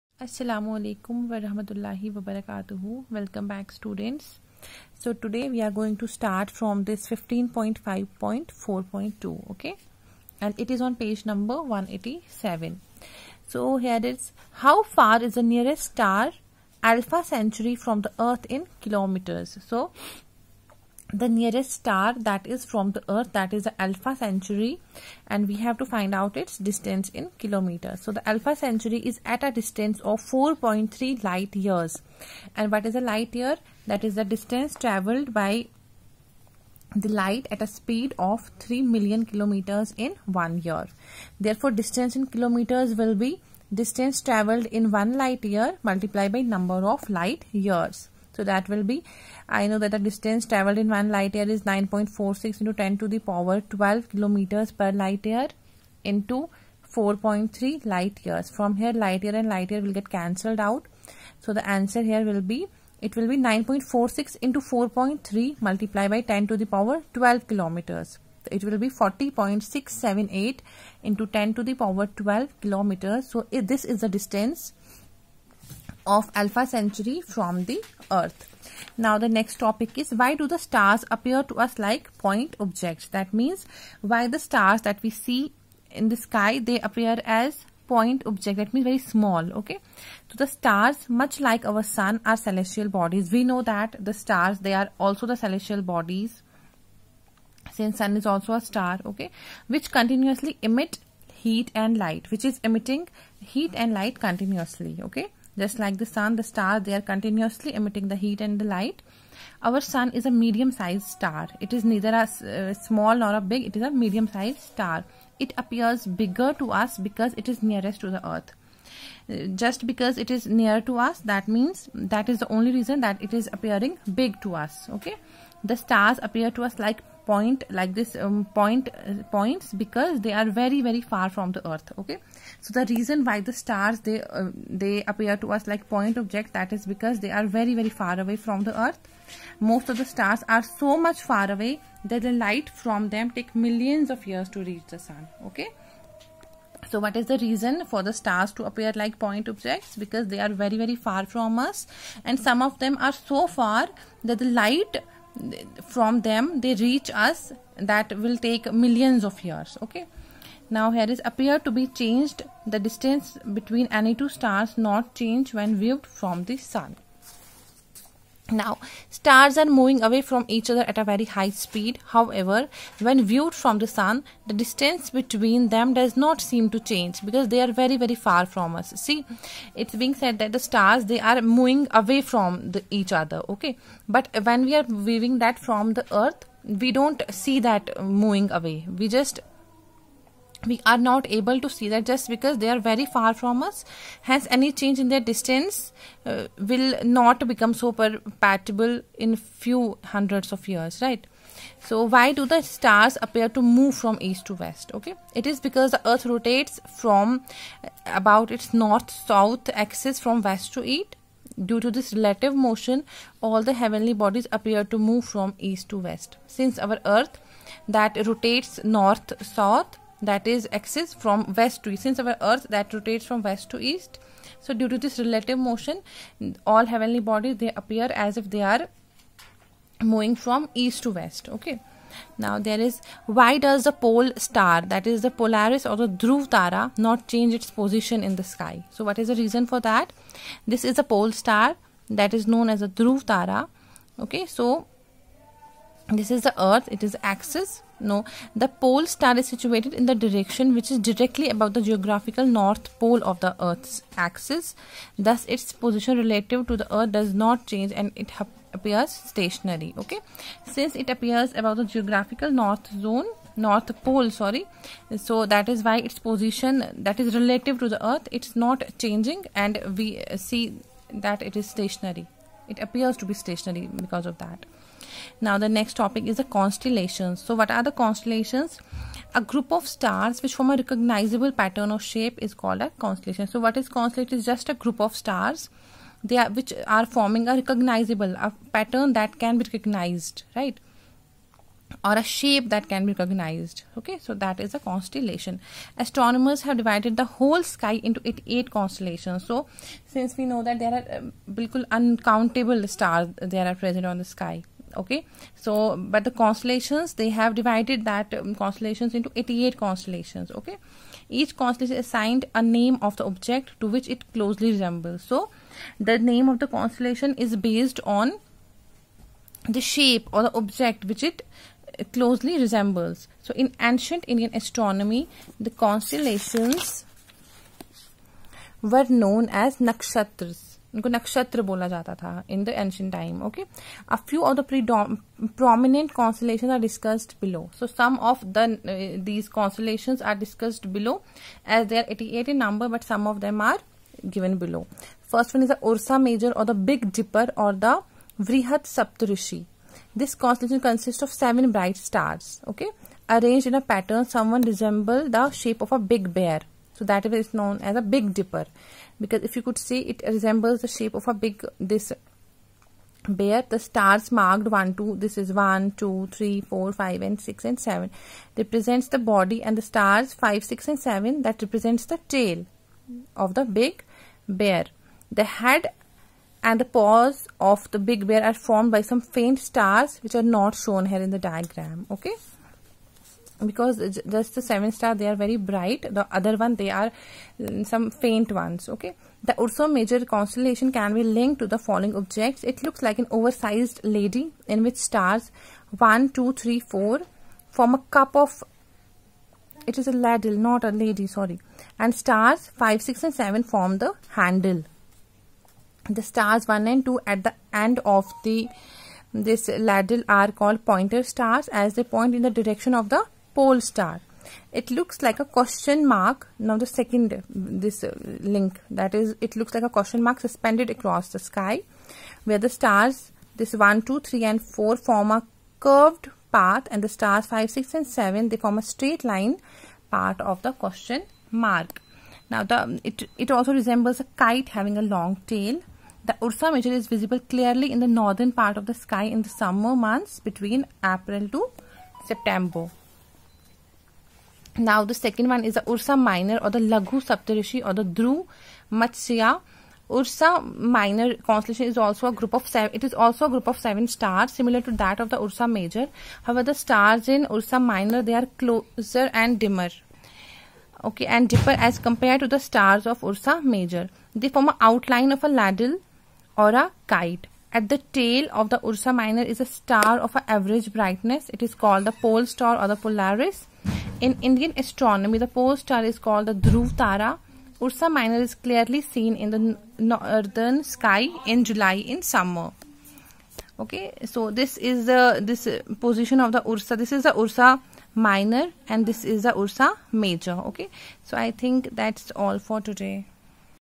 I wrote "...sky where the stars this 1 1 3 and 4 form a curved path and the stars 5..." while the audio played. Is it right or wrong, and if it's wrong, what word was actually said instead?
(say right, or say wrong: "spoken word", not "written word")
wrong: "2", not "1".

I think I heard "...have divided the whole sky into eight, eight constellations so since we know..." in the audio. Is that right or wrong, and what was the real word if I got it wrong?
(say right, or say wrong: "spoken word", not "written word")
right.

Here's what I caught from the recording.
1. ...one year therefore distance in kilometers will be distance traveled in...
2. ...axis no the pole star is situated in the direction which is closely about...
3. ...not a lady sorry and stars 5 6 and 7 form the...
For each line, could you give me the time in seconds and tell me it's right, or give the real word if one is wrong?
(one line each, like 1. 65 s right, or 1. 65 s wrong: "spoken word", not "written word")
1. 40 s right
2. 247 s wrong: "directly", not "closely"
3. 400 s right.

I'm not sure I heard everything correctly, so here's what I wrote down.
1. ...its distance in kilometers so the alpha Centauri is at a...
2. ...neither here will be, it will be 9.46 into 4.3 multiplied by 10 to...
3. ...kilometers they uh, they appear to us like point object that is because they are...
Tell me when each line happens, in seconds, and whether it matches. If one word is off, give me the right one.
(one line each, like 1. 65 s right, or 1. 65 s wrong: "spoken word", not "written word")
1. 26 s right
2. 61 s wrong: "answer", not "neither"
3. 133 s wrong: "stars", not "kilometers".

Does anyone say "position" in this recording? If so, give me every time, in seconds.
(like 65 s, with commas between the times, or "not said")
237 s, 255 s, 266 s, 485 s.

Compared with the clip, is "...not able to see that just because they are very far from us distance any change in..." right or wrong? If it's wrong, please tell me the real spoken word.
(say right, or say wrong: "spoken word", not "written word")
wrong: "hence", not "distance".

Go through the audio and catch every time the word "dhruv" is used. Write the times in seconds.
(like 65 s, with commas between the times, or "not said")
236 s, 242 s, 448 s, 476 s.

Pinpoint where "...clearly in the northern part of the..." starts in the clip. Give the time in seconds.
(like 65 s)
437 s.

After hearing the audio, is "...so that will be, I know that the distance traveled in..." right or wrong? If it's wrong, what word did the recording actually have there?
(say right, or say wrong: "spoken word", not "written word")
right.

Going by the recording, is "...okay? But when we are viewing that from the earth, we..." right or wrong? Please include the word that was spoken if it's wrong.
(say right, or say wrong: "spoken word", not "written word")
right.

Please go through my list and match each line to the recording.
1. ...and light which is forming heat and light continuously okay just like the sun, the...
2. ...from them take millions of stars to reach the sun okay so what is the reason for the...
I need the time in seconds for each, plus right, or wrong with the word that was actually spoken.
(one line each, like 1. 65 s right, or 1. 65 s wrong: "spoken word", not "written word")
1. 101 s wrong: "emitting", not "forming"
2. 142 s wrong: "years", not "stars".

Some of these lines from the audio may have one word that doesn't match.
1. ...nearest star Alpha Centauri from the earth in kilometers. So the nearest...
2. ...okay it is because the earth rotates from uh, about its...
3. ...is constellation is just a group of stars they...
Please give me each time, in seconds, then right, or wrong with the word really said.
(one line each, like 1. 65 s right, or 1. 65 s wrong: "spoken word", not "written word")
1. 15 s right
2. 204 s right
3. 283 s right.